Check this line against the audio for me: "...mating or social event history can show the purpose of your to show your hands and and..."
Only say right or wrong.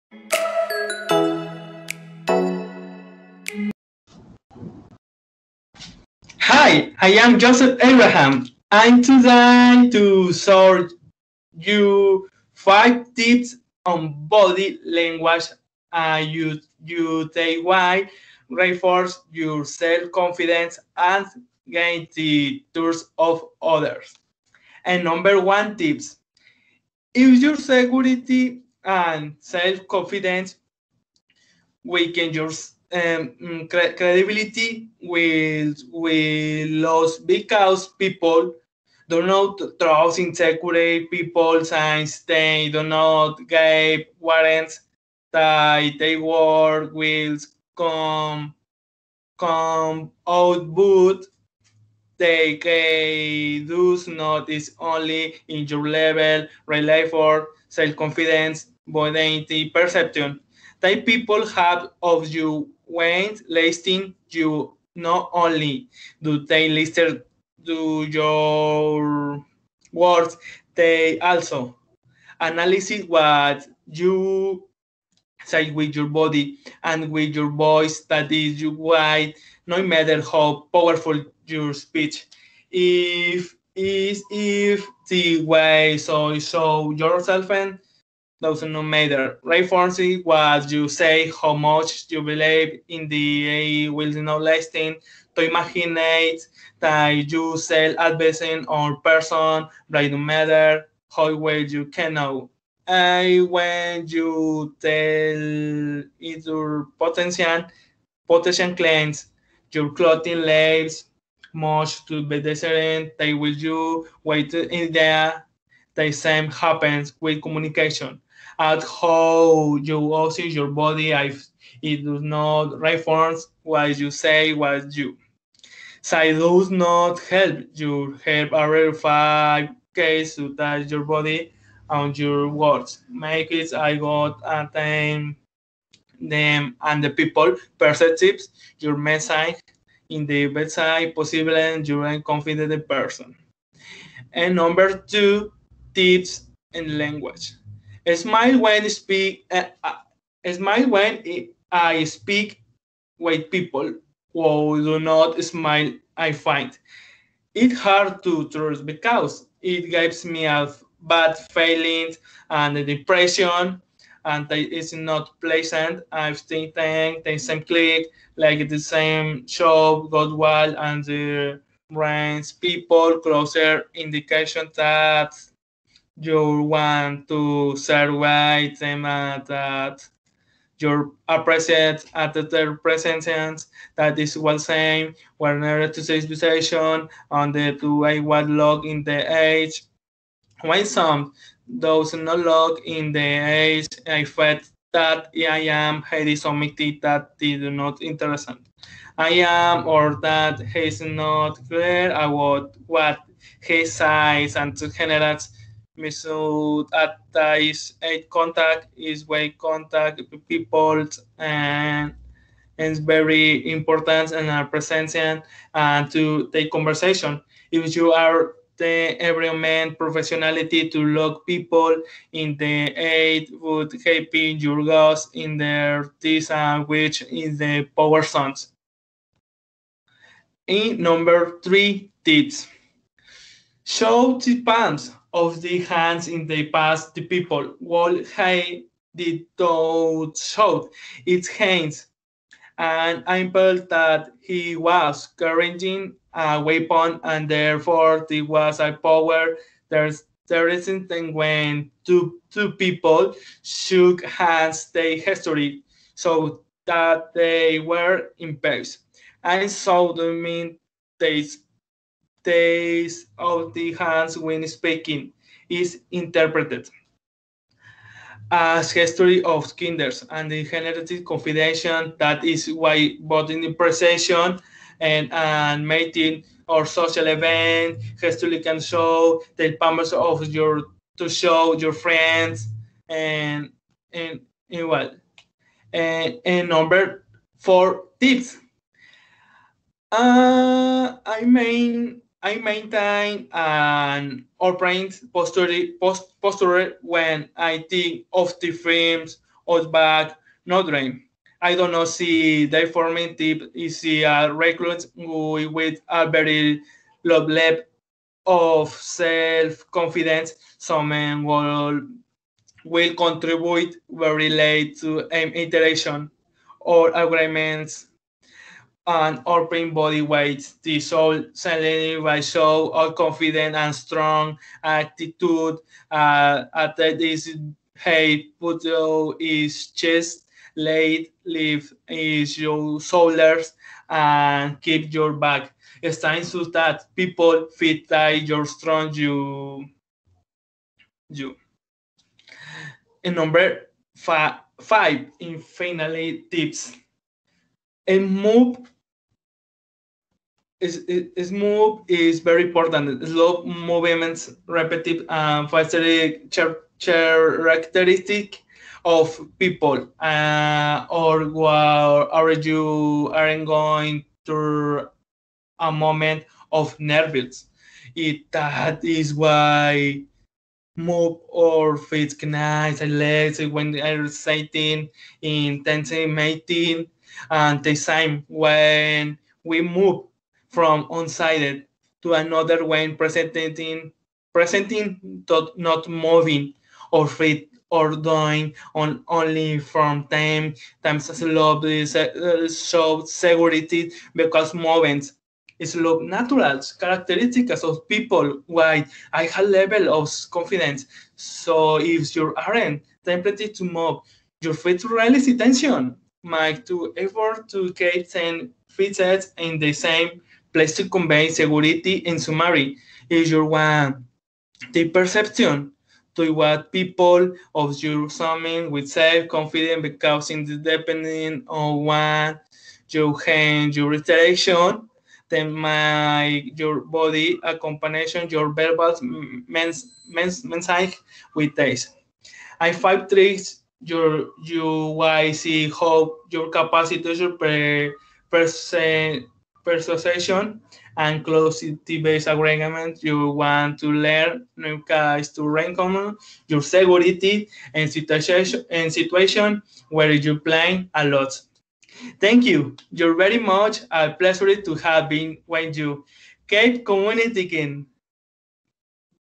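wrong.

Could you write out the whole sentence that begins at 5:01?
I don't know see the forming tip is a recruit with a very low level of self-confidence.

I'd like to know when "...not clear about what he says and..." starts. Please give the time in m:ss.
3:21.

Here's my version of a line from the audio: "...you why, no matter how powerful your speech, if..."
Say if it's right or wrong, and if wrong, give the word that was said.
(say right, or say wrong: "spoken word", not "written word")
right.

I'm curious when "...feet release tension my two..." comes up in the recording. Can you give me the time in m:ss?
6:44.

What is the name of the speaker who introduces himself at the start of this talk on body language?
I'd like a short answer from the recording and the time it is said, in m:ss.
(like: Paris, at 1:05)
Joseph Abraham, at 0:07.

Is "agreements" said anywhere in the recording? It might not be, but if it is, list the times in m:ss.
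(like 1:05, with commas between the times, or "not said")
5:17, 7:22.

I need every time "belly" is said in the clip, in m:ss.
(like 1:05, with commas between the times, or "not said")
not said.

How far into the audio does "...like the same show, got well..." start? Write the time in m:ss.
2:48.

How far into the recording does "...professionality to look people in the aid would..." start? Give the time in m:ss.
3:39.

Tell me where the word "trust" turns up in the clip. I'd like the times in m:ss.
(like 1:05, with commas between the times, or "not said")
0:22, 0:39, 2:38.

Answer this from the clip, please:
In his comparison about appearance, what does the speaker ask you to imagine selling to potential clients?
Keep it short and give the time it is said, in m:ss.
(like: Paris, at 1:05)
advertising, at 1:37.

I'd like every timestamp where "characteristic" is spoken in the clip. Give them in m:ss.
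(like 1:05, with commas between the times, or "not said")
5:56, 6:36.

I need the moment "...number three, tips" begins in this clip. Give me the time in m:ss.
3:51.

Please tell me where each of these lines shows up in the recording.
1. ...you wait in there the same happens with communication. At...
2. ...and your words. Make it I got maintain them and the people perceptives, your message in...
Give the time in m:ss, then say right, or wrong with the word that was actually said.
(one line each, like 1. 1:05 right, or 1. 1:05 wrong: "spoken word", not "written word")
1. 1:53 right
2. 2:11 wrong: "attain", not "maintain".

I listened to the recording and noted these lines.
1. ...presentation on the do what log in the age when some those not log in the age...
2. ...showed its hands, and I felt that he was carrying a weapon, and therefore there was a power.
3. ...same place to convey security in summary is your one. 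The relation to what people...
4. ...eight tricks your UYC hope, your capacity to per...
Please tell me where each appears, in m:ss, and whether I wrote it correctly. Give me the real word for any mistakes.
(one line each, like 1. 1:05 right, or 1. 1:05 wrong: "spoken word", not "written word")
1. 3:06 wrong: "situation", not "presentation"
2. 4:00 right
3. 6:49 wrong: "perception", not "relation"
4. 7:12 wrong: "five", not "eight".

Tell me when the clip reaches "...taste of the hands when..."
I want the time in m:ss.
4:22.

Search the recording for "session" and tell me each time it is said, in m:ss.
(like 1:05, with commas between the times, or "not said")
not said.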